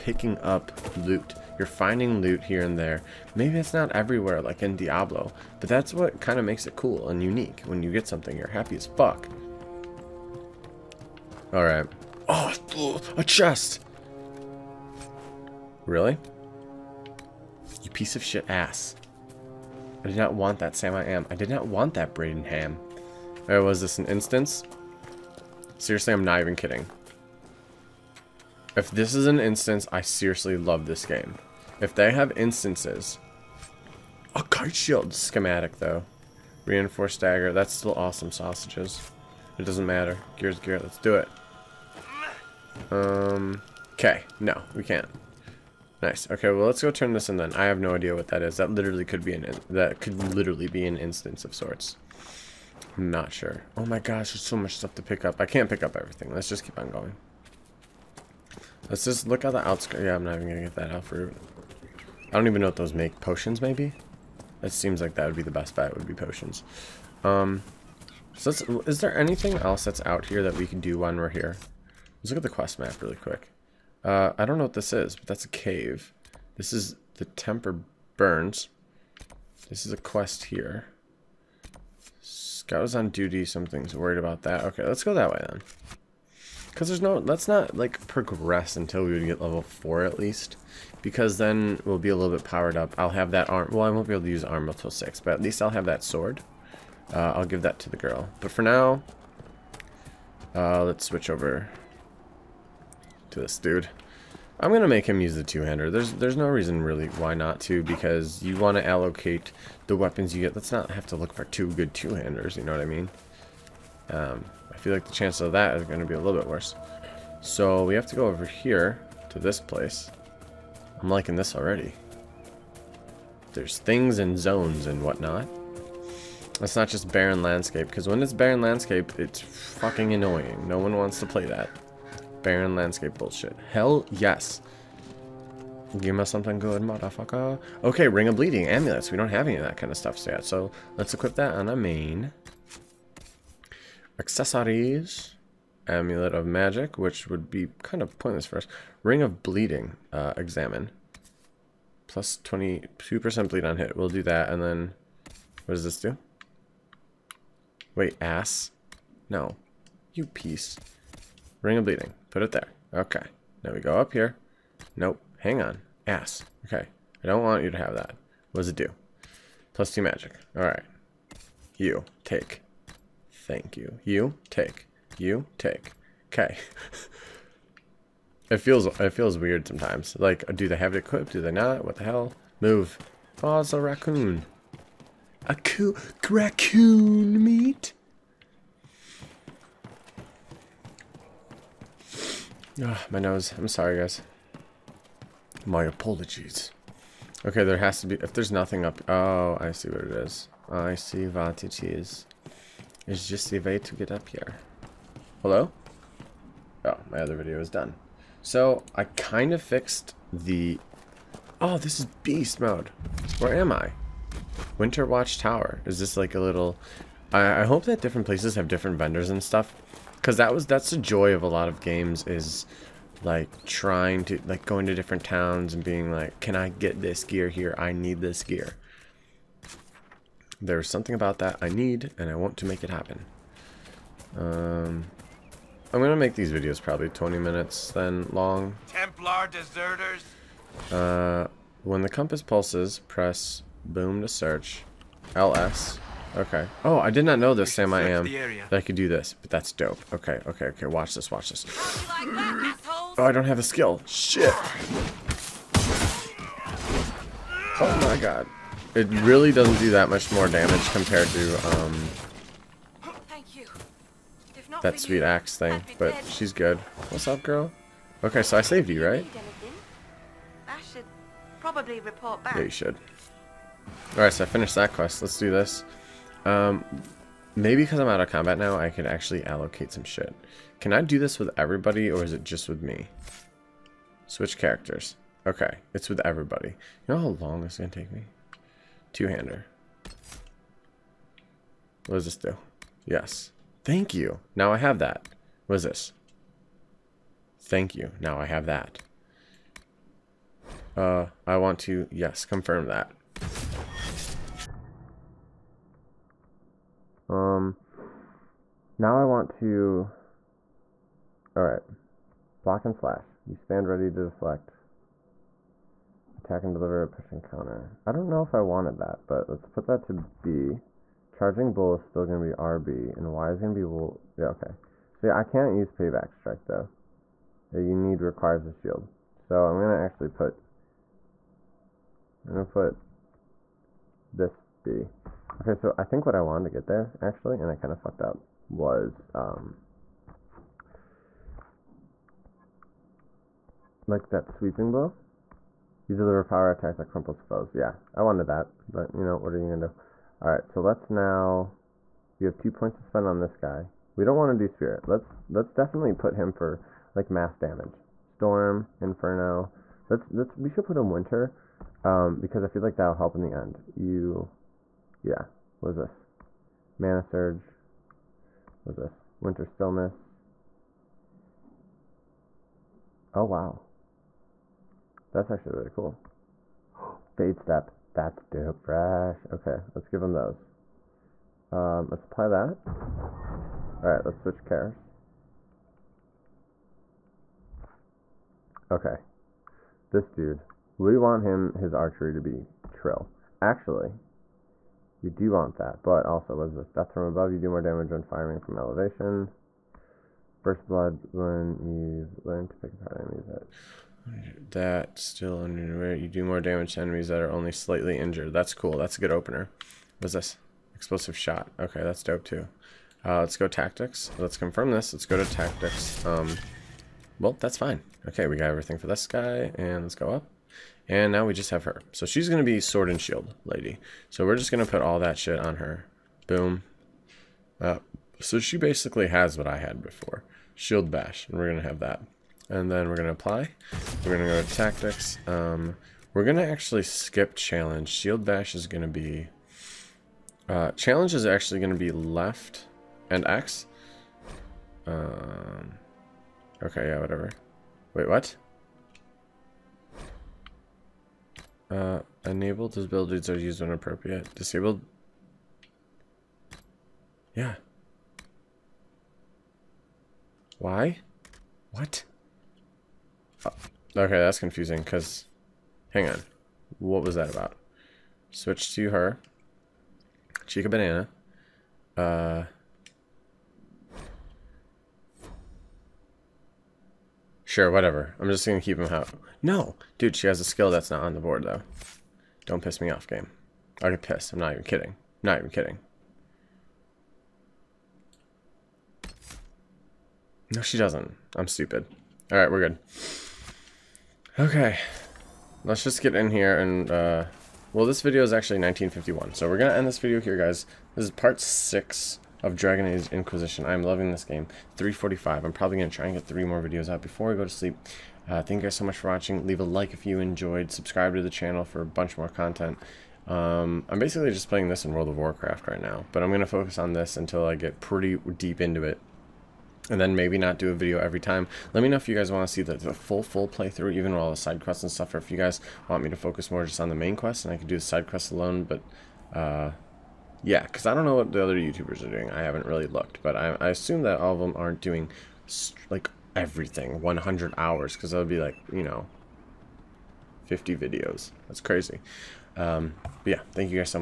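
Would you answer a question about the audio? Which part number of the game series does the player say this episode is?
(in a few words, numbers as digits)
6.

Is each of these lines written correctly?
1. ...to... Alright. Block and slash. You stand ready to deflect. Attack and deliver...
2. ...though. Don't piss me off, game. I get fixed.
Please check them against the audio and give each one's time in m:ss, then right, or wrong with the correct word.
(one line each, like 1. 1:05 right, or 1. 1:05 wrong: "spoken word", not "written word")
1. 5:09 right
2. 8:01 wrong: "pissed", not "fixed".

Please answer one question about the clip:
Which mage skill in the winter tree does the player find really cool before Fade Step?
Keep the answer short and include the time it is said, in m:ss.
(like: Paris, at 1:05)
Winter Stillness, at 6:09.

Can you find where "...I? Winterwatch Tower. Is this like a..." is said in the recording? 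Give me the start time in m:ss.
3:33.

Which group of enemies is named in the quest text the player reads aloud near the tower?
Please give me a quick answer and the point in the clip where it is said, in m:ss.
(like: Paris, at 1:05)
Templar deserters, at 3:58.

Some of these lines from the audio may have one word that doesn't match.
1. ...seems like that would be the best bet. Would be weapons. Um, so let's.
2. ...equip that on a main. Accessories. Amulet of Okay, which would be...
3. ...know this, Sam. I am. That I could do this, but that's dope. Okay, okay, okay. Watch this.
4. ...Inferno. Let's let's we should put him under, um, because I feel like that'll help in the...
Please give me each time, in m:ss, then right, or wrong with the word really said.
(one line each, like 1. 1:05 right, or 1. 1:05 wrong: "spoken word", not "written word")
1. 1:04 wrong: "potions", not "weapons"
2. 2:21 wrong: "Magic", not "Okay"
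3. 4:07 right
4. 5:58 wrong: "winter", not "under".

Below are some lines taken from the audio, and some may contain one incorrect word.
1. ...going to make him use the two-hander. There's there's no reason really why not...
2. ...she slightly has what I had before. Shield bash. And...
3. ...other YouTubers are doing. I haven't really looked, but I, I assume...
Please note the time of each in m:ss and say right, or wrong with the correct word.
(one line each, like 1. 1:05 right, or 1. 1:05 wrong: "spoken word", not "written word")
1. 1:44 right
2. 7:08 wrong: "basically", not "slightly"
3. 8:51 right.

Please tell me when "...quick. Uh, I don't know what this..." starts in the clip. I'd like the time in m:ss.
1:13.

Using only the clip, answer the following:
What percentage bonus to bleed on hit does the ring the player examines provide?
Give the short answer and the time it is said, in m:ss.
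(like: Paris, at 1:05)
22%, at 2:32.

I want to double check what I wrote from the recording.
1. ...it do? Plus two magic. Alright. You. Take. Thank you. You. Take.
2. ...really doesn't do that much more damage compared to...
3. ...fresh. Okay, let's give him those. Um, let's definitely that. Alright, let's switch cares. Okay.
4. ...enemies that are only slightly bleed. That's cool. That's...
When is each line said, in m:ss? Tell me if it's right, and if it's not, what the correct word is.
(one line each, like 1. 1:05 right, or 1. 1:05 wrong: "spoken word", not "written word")
1. 2:48 right
2. 4:19 right
3. 6:18 wrong: "apply", not "definitely"
4. 6:47 wrong: "injured", not "bleed".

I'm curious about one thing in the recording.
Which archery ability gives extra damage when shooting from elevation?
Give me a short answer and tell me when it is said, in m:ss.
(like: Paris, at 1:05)
Death from above, at 6:36.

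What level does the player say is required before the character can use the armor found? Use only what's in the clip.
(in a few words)
6.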